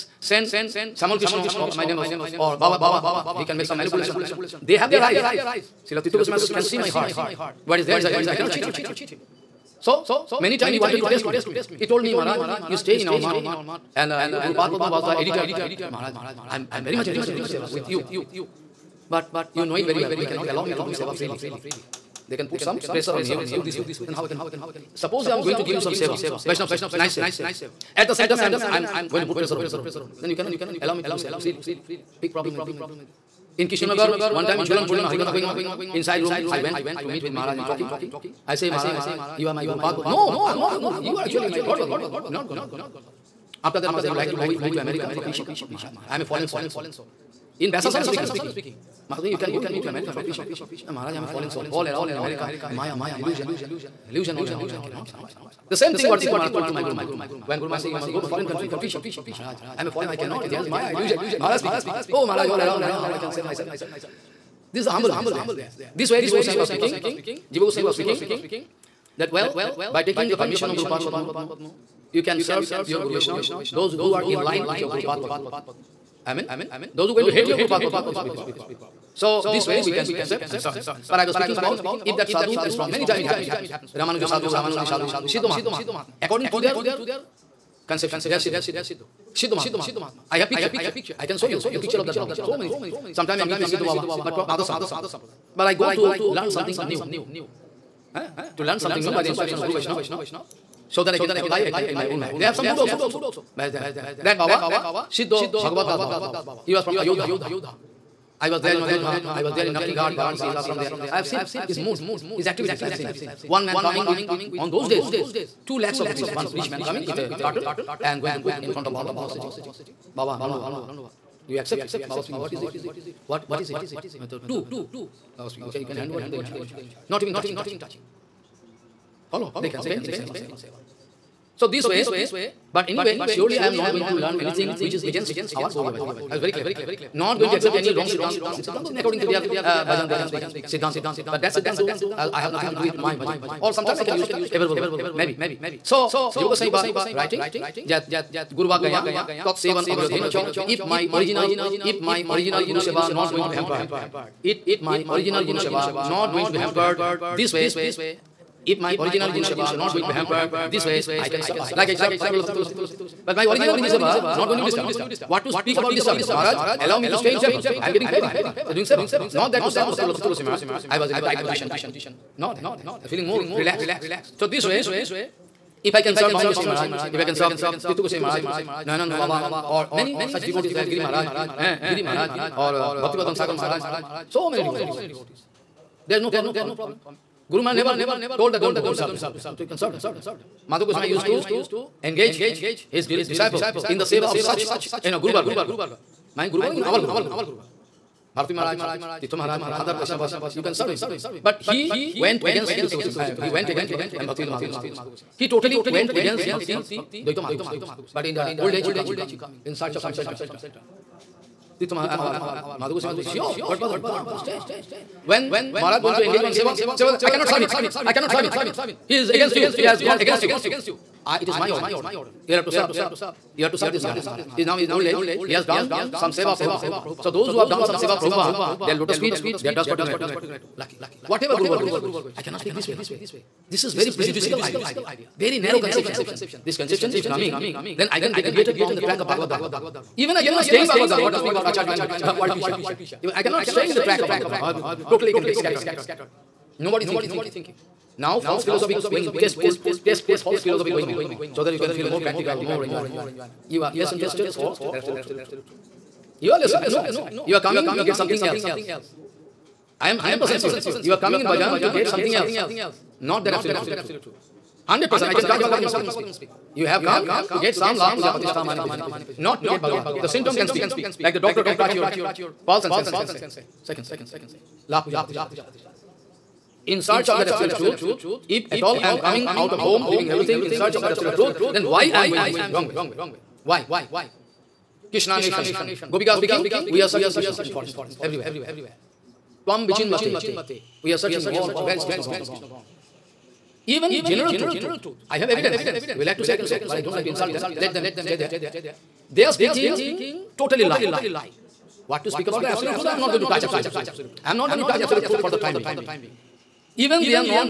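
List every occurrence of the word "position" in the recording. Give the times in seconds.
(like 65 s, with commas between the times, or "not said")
171 s.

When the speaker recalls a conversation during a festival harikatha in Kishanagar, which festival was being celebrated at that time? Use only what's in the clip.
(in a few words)
Julan Purnima.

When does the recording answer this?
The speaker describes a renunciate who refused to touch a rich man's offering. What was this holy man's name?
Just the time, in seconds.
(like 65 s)
105 s.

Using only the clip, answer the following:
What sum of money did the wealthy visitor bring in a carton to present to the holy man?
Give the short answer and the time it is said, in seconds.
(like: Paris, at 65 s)
2 lakh rupees, at 115 s.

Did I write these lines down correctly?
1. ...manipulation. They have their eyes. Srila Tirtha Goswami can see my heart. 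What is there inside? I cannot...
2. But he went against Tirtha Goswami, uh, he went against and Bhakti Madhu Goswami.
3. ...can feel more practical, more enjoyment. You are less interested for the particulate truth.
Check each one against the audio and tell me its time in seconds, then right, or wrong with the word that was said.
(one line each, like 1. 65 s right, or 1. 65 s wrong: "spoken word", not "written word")
1. 3 s right
2. 201 s right
3. 251 s wrong: "absolute", not "particulate".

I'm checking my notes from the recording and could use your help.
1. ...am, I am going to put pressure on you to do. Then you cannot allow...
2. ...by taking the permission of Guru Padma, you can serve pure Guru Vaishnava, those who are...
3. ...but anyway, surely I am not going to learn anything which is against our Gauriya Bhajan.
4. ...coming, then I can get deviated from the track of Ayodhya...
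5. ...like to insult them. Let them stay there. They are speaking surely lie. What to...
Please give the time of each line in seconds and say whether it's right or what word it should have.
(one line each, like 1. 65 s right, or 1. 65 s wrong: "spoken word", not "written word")
1. 28 s right
2. 69 s right
3. 132 s right
4. 237 s wrong: "Bhagavad", not "Ayodhya"
5. 297 s wrong: "totally", not "surely".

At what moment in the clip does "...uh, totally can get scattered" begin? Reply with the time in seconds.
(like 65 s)
244 s.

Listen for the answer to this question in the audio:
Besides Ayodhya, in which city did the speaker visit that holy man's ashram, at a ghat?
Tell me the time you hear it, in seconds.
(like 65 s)
110 s.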